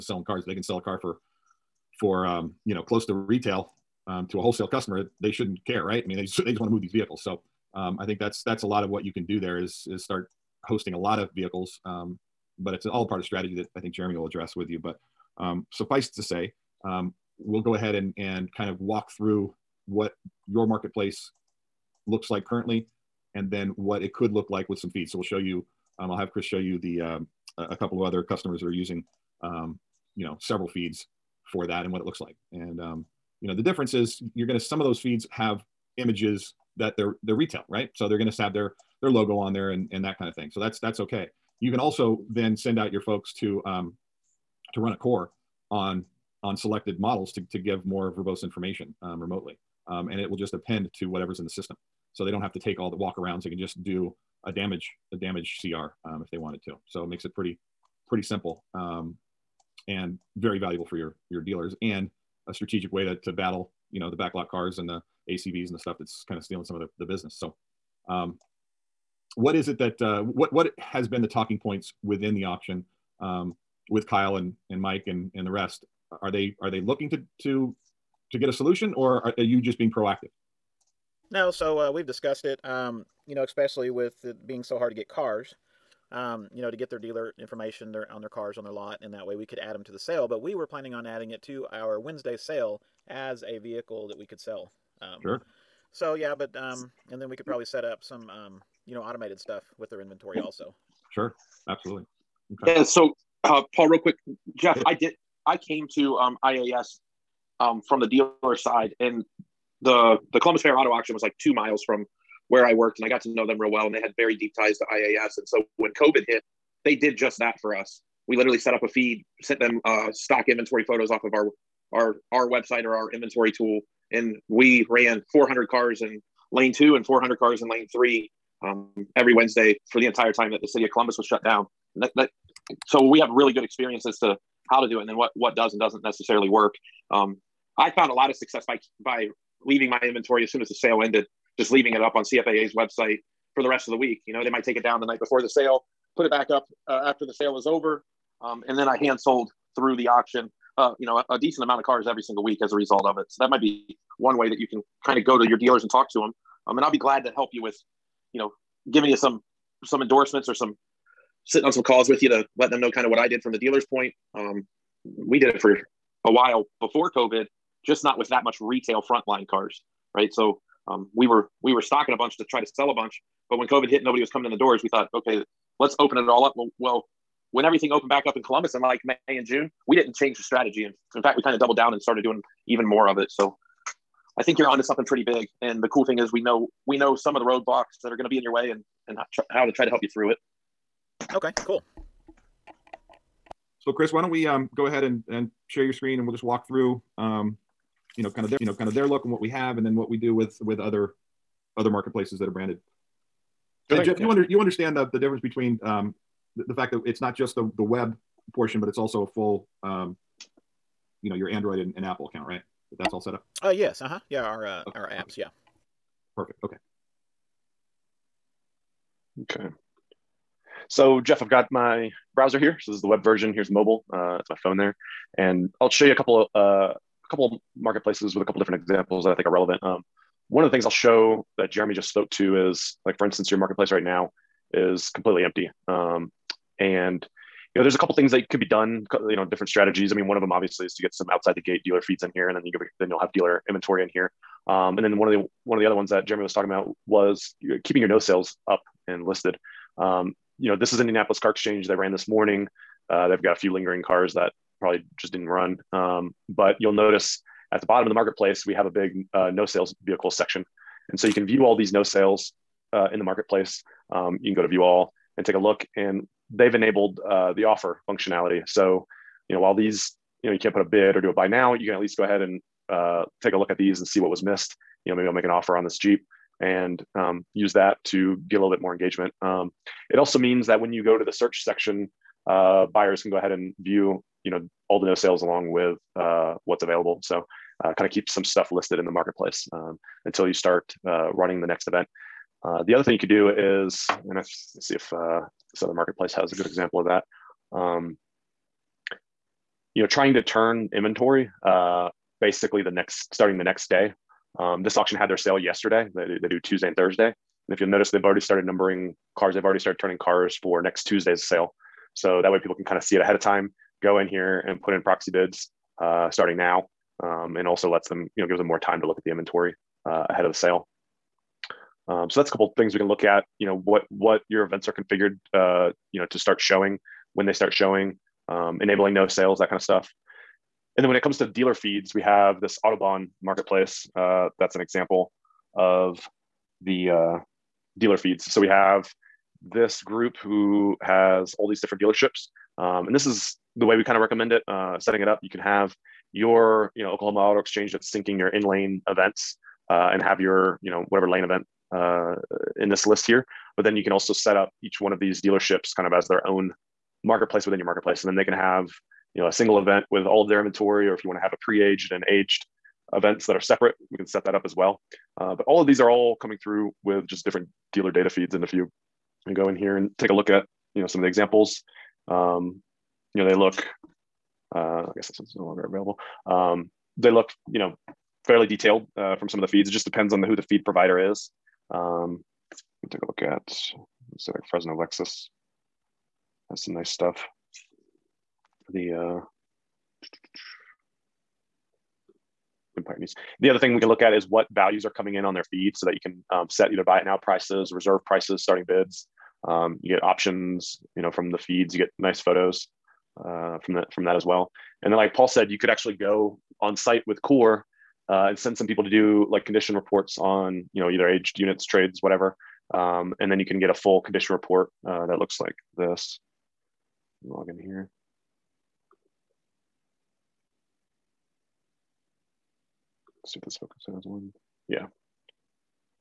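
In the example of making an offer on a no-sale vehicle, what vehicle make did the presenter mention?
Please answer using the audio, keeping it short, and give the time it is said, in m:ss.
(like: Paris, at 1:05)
Jeep, at 4:35.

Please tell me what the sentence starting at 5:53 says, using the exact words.
But then you can also set up each one of these dealerships kind of as their own marketplace within your marketplace.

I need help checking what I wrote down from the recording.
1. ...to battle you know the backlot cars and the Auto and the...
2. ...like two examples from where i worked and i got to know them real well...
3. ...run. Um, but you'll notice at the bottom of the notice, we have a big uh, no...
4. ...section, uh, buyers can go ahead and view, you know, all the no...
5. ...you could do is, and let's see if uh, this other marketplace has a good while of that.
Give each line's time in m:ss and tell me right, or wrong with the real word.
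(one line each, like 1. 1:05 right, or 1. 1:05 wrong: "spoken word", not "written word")
1. 1:03 wrong: "ACVs", not "Auto"
2. 1:51 wrong: "miles", not "examples"
3. 4:15 wrong: "marketplace", not "notice"
4. 4:41 right
5. 4:53 wrong: "example", not "while".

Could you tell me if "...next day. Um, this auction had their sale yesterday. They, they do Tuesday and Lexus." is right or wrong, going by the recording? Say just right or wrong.
wrong.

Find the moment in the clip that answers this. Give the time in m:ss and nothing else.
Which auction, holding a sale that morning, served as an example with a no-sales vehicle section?
4:11.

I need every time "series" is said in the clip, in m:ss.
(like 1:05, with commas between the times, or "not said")
not said.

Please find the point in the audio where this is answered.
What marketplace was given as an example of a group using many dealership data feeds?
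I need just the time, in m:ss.
5:32.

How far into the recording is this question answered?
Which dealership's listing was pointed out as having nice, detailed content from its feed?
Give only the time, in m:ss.
6:24.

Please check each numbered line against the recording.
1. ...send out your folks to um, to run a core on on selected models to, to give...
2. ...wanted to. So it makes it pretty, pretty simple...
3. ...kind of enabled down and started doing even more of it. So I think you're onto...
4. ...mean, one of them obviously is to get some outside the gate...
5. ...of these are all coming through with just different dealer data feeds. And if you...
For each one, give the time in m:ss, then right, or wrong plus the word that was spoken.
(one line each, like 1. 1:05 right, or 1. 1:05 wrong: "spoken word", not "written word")
1. 0:42 right
2. 0:56 right
3. 3:01 wrong: "doubled", not "enabled"
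4. 4:00 right
5. 6:05 right.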